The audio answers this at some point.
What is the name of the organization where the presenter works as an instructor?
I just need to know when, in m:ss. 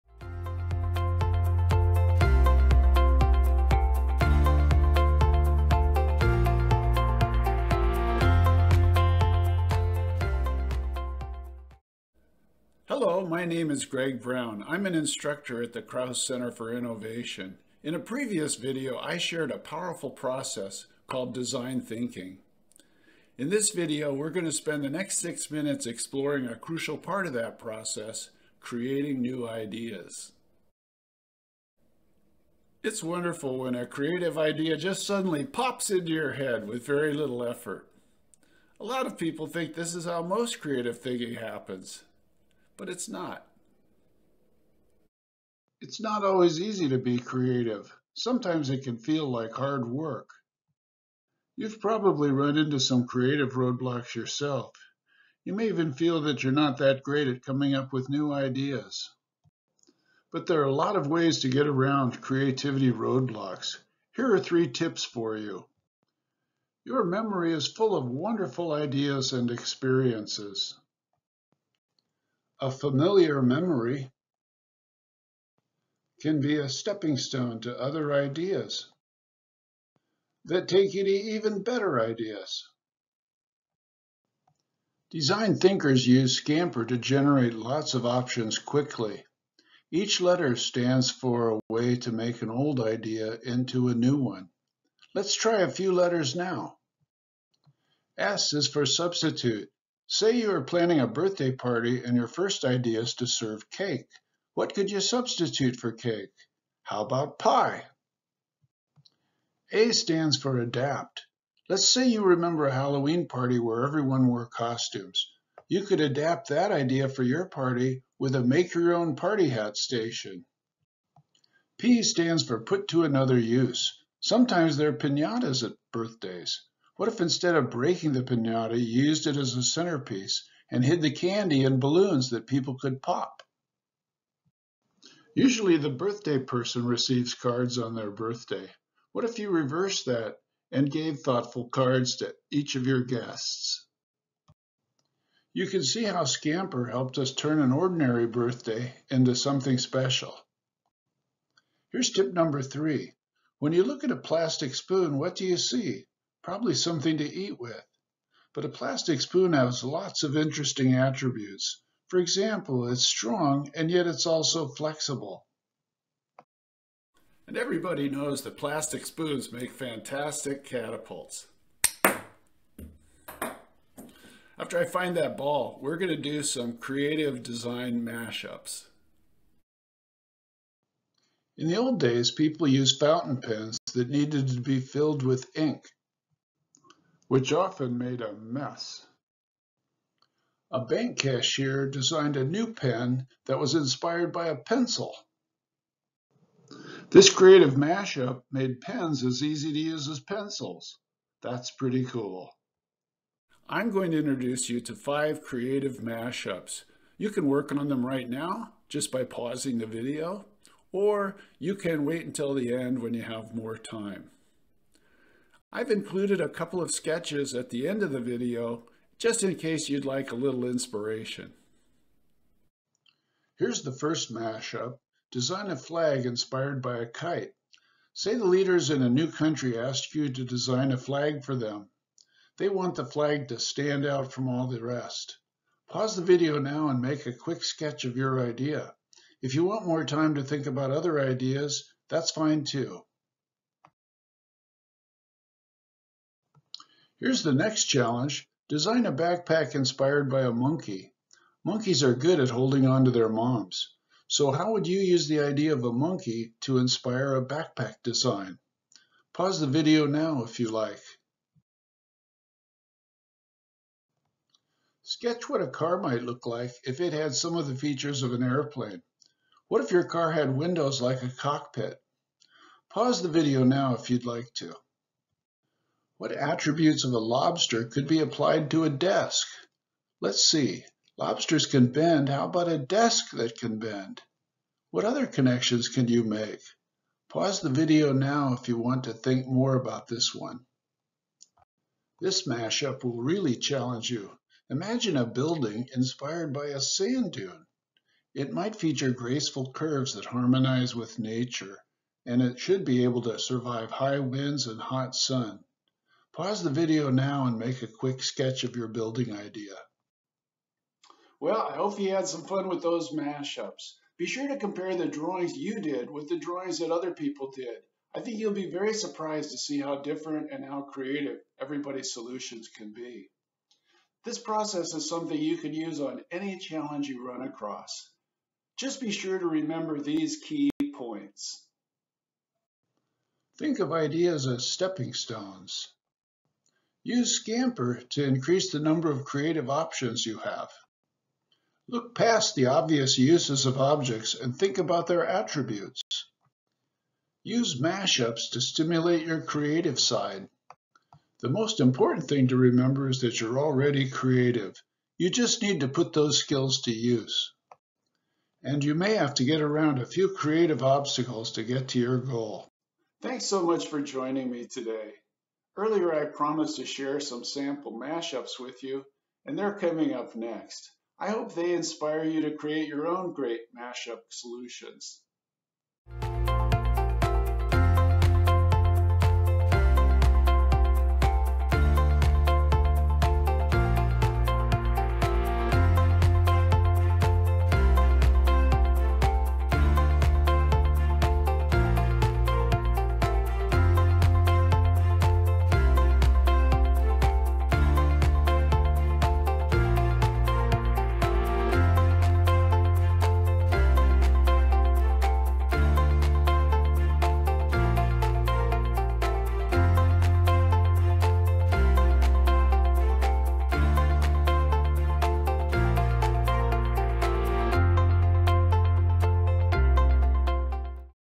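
0:15.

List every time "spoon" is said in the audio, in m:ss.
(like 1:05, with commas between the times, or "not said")
2:34, 2:39, 2:49.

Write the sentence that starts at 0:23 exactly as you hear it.
In this video, we're going to spend the next six minutes exploring a crucial part of that process, creating new ideas.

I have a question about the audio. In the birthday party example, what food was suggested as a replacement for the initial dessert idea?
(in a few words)
Pie.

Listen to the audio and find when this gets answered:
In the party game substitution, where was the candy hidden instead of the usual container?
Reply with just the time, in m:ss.
2:11.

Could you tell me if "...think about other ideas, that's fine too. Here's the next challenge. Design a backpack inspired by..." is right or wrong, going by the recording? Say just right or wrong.
right.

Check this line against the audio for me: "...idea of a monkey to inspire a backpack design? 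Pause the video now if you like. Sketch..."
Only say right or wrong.
right.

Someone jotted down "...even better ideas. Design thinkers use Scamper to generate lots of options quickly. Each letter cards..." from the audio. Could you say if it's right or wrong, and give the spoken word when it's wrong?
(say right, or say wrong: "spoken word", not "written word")
wrong: "stands", not "cards".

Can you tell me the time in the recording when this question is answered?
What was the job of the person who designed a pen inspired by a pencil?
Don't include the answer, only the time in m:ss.
3:10.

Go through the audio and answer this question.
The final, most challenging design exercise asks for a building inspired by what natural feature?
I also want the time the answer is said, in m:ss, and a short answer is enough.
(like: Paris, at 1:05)
Sand dune, at 4:56.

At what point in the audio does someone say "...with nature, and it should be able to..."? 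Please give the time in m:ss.
5:00.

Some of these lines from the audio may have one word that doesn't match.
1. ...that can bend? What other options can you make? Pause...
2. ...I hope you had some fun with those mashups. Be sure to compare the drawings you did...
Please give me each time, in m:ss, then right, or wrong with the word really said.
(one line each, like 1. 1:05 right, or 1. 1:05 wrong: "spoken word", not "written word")
1. 4:43 wrong: "connections", not "options"
2. 5:11 right.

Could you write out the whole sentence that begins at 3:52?
They want the flag to stand out from all the rest.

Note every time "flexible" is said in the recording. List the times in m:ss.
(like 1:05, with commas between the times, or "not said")
2:44.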